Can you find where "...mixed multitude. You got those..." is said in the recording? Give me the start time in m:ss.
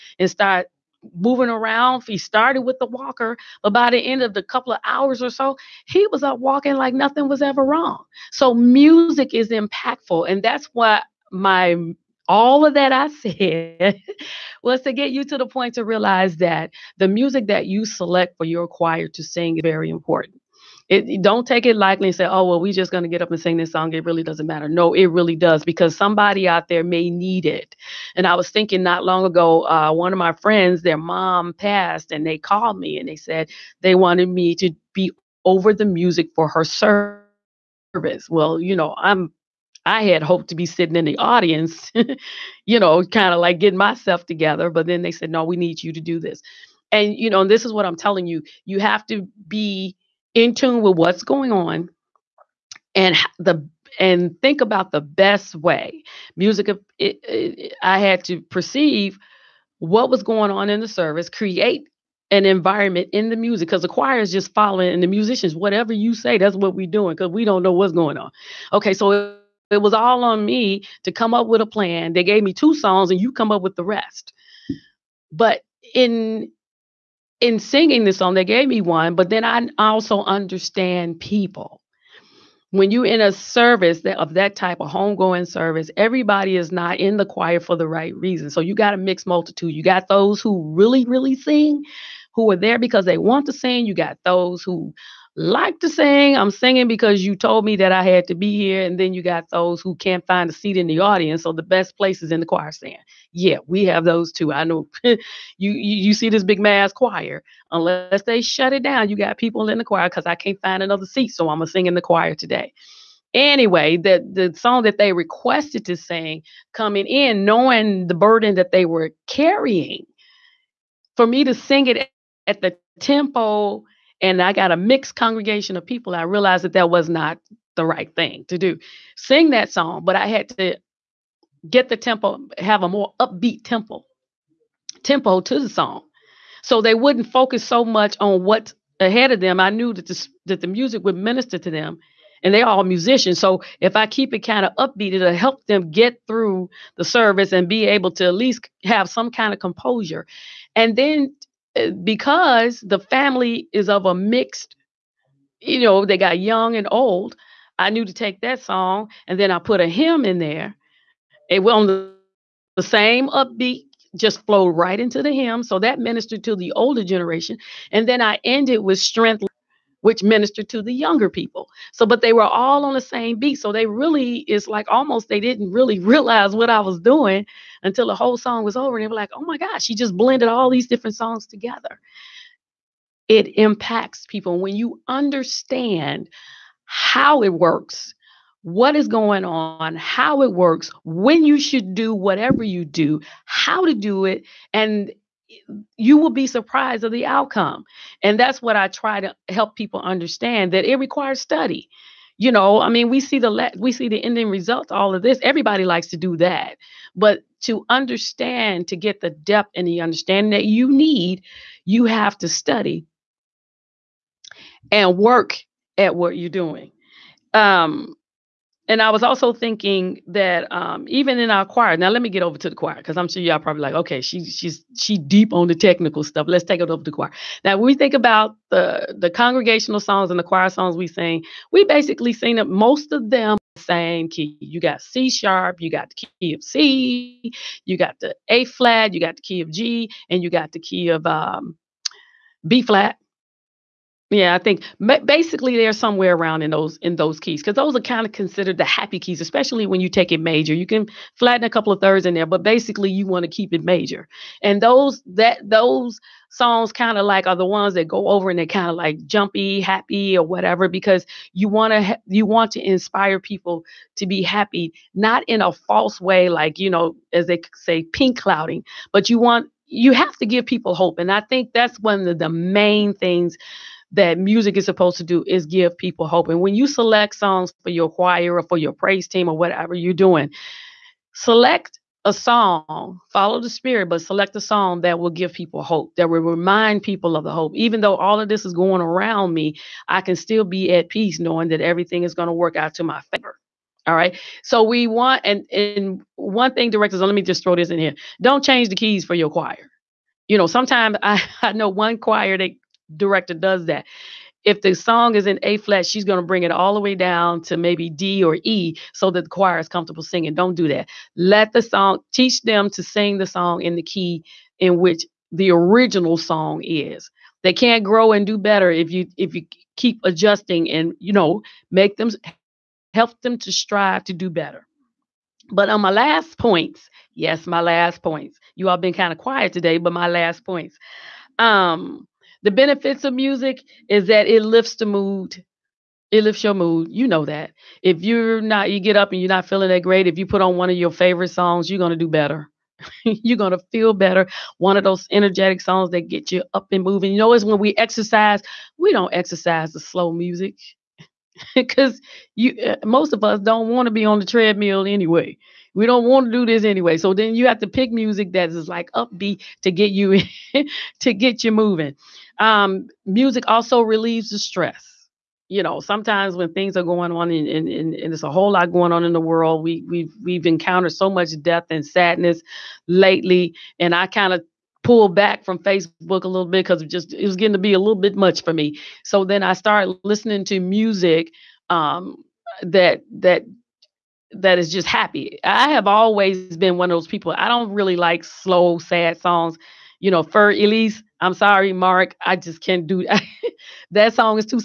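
1:28.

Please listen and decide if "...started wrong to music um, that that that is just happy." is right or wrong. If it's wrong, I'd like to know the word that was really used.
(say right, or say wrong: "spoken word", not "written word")
wrong: "listening", not "wrong".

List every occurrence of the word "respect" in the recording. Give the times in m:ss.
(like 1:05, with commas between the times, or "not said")
not said.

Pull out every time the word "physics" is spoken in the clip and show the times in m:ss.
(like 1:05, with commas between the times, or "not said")
not said.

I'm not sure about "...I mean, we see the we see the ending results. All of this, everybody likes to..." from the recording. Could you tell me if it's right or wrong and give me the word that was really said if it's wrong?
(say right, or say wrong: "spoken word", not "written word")
right.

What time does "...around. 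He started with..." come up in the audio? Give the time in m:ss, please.
0:01.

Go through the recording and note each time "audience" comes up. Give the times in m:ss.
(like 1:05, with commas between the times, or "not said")
0:41, 1:41.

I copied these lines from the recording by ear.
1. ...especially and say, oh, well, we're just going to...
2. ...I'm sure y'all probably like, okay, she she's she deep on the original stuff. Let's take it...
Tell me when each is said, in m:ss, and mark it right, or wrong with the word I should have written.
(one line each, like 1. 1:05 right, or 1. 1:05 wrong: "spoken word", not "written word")
1. 0:21 wrong: "lightly", not "especially"
2. 3:43 wrong: "technical", not "original".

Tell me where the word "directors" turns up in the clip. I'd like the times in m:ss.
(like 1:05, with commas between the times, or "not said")
4:56, 5:03.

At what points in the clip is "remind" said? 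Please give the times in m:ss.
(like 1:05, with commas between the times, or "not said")
4:46.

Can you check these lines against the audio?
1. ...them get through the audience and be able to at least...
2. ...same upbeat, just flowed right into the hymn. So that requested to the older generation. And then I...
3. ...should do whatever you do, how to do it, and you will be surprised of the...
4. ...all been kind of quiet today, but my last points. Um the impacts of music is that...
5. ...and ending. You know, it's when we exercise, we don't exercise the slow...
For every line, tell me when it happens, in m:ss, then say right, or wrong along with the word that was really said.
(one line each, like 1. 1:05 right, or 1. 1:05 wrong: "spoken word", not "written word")
1. 2:25 wrong: "service", not "audience"
2. 2:42 wrong: "ministered", not "requested"
3. 3:11 right
4. 5:28 wrong: "benefits", not "impacts"
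5. 5:46 wrong: "moving", not "ending".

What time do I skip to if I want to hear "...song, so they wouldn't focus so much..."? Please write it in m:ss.
2:15.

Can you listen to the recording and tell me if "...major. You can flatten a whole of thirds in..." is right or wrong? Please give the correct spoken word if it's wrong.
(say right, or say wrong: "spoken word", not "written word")
wrong: "couple", not "whole".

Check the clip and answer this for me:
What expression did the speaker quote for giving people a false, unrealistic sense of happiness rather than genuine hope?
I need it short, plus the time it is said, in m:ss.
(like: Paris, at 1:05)
pink clouding, at 4:28.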